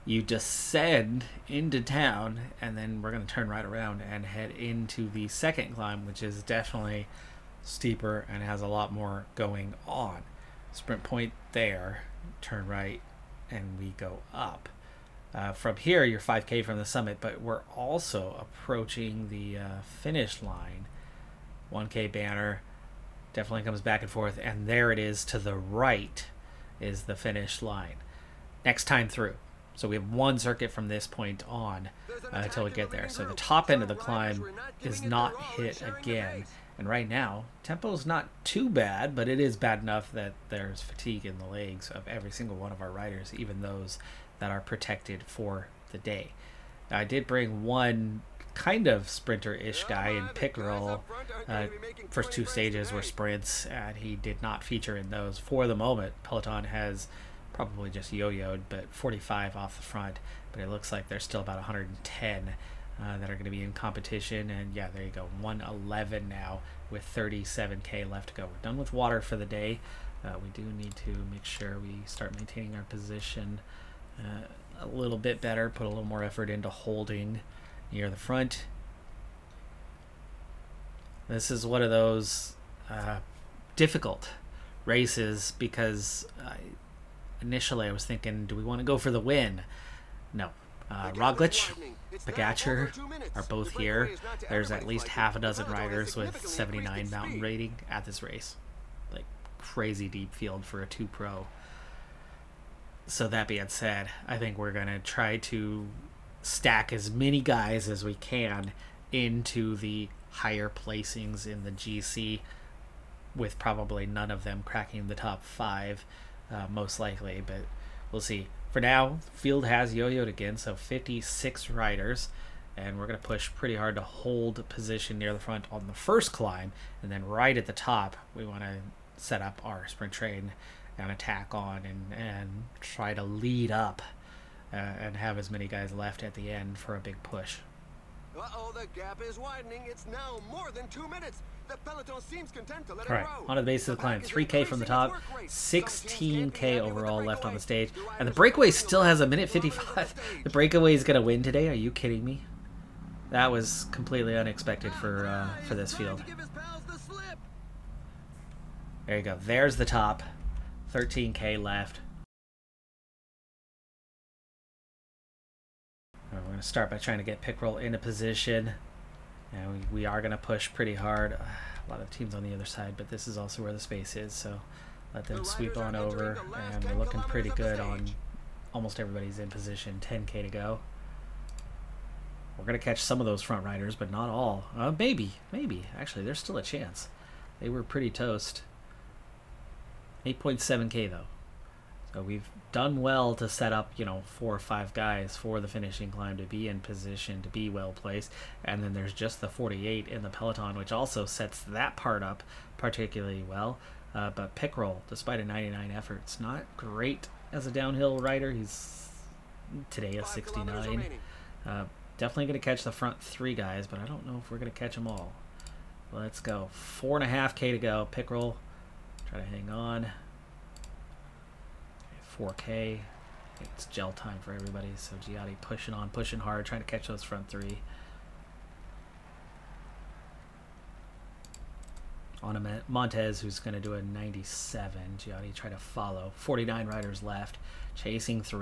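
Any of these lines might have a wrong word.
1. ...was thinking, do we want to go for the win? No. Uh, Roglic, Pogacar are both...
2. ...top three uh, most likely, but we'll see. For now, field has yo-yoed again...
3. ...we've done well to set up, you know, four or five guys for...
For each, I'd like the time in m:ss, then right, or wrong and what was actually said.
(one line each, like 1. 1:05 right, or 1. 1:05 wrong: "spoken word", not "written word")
1. 1:27 right
2. 1:55 wrong: "five", not "three"
3. 3:12 right.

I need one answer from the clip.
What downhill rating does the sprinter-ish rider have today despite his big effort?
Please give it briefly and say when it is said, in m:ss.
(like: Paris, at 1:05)
69, at 3:30.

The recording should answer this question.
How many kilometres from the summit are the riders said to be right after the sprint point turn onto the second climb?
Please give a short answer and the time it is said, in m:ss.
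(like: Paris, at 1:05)
5K, at 0:16.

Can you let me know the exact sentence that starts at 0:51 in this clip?
Uh, first two stages were sprints, and he did not feature in those for the moment.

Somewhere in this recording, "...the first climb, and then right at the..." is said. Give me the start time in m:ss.
2:05.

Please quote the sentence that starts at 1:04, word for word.
And yeah, there you go, 111 now with 37k left to go.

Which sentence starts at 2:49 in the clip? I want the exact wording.
And we, we are going to push pretty hard.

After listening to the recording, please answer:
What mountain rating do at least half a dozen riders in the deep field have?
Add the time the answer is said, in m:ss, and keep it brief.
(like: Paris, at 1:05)
79, at 1:36.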